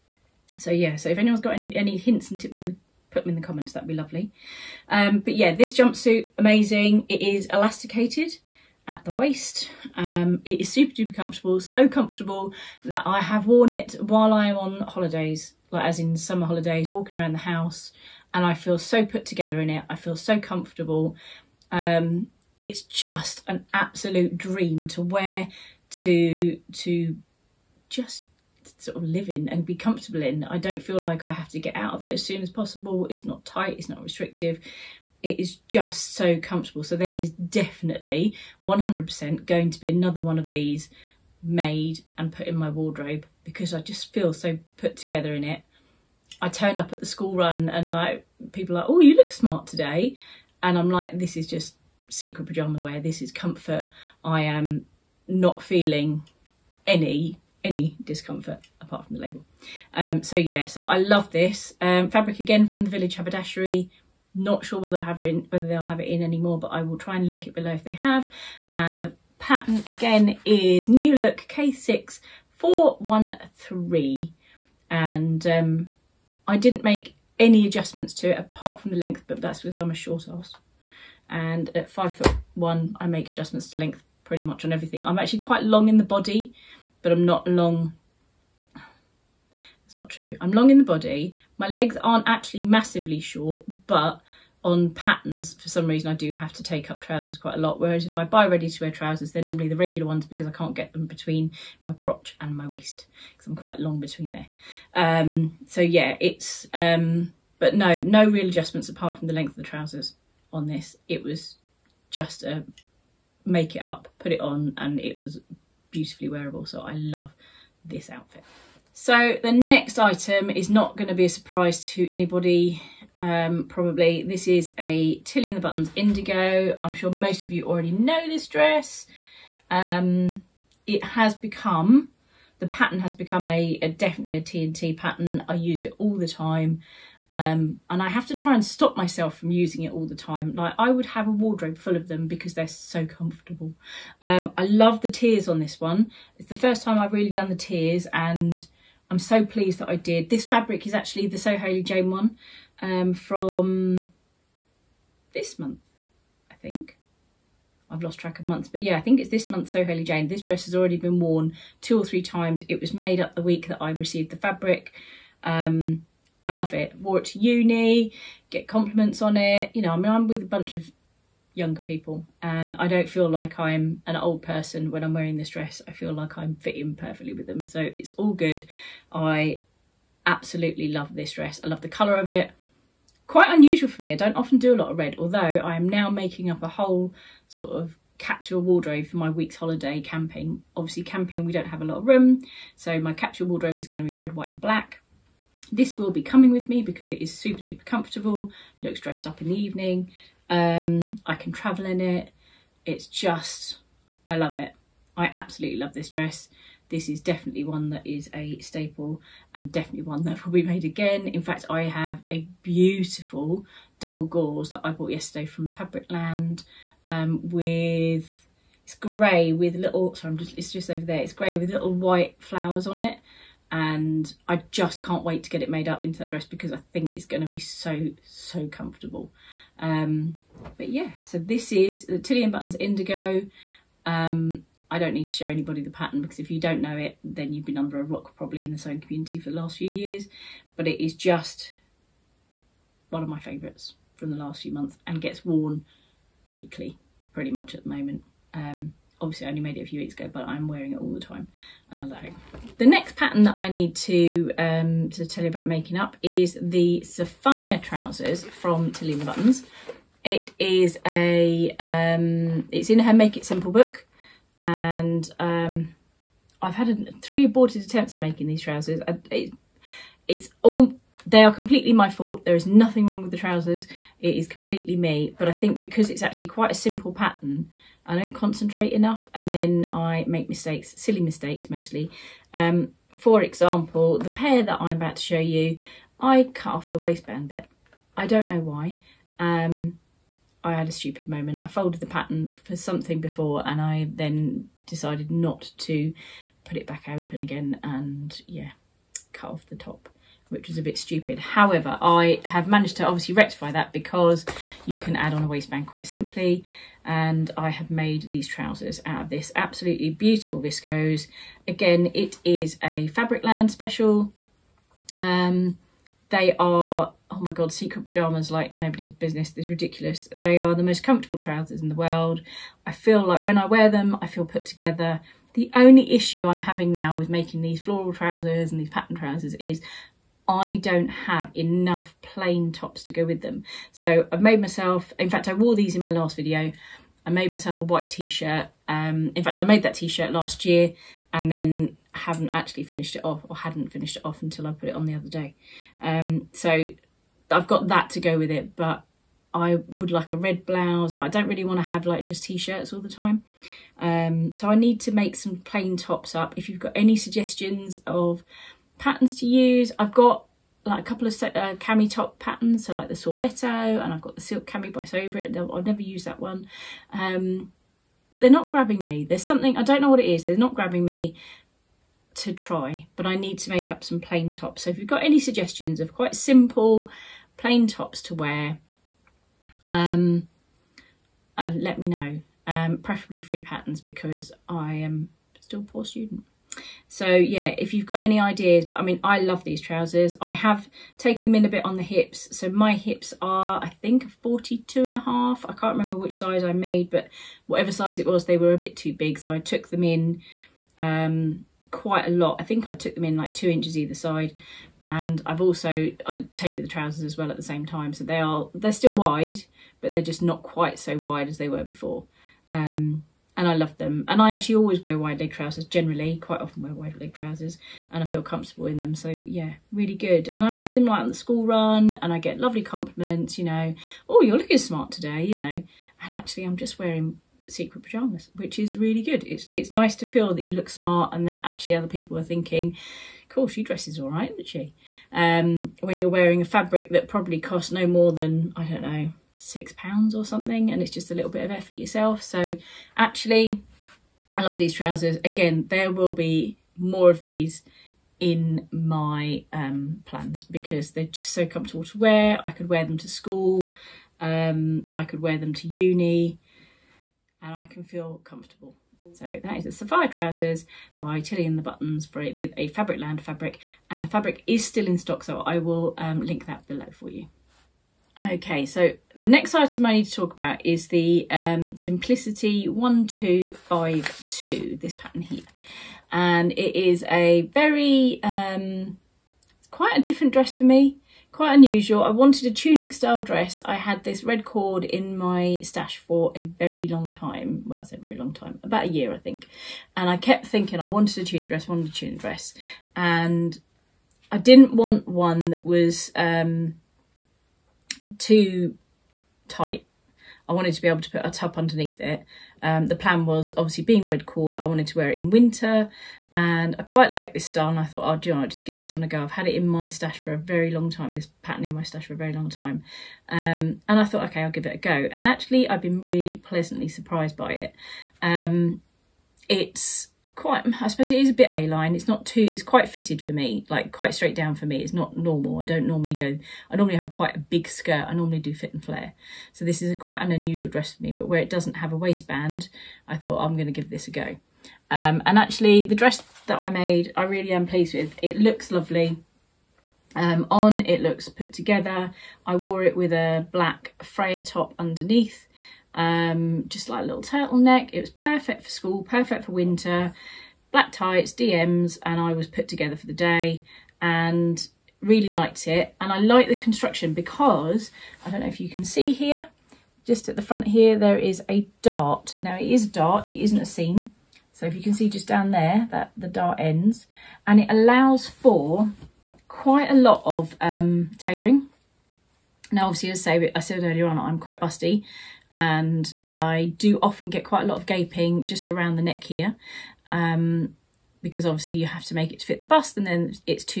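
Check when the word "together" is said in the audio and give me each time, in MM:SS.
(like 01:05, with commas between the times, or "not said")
00:19, 00:44, 05:24, 09:01, 09:12.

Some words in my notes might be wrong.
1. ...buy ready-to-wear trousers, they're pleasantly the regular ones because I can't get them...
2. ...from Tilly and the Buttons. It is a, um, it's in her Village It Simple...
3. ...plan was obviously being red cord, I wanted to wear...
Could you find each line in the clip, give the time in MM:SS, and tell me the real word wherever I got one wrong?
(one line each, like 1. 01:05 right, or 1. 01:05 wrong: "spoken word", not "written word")
1. 01:38 wrong: "normally", not "pleasantly"
2. 04:18 wrong: "Make", not "Village"
3. 08:23 right.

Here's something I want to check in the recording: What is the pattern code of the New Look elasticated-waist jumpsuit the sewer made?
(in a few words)
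K6413.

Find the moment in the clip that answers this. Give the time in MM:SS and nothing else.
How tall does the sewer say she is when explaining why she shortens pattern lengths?
01:21.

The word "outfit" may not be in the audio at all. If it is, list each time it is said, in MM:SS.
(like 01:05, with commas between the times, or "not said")
01:58.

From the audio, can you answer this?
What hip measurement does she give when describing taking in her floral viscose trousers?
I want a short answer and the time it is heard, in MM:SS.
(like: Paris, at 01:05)
42 and a half, at 06:34.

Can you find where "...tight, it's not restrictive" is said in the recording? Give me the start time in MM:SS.
00:33.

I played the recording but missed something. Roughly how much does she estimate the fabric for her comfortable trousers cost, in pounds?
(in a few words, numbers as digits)
6 pounds.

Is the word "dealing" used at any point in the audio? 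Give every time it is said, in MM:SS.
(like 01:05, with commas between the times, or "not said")
not said.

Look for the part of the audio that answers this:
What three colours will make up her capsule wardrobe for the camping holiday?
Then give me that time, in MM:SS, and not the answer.
03:14.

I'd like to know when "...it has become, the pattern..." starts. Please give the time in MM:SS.
02:10.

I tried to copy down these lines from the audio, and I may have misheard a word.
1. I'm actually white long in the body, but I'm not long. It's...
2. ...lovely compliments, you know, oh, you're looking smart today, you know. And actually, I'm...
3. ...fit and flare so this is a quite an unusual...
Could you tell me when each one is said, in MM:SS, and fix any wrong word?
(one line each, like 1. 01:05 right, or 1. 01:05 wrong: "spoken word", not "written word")
1. 01:25 wrong: "quite", not "white"
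2. 07:02 right
3. 08:48 right.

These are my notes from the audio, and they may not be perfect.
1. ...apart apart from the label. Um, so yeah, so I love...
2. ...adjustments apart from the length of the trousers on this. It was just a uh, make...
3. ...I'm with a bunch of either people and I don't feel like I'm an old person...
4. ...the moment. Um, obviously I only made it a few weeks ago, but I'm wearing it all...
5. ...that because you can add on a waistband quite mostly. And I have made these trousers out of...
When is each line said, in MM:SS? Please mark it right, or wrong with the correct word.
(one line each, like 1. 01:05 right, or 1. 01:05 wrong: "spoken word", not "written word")
1. 00:58 wrong: "discomfort", not "apart"
2. 01:48 right
3. 02:50 wrong: "younger", not "either"
4. 04:07 right
5. 05:03 wrong: "simply", not "mostly".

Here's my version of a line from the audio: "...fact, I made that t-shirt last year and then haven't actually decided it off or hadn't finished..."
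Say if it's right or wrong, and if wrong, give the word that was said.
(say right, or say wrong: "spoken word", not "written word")
wrong: "finished", not "decided".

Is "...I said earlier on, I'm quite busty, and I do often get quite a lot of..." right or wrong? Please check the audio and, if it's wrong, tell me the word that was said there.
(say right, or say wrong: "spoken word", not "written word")
right.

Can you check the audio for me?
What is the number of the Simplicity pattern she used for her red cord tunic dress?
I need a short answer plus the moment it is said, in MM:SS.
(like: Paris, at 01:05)
1252, at 07:52.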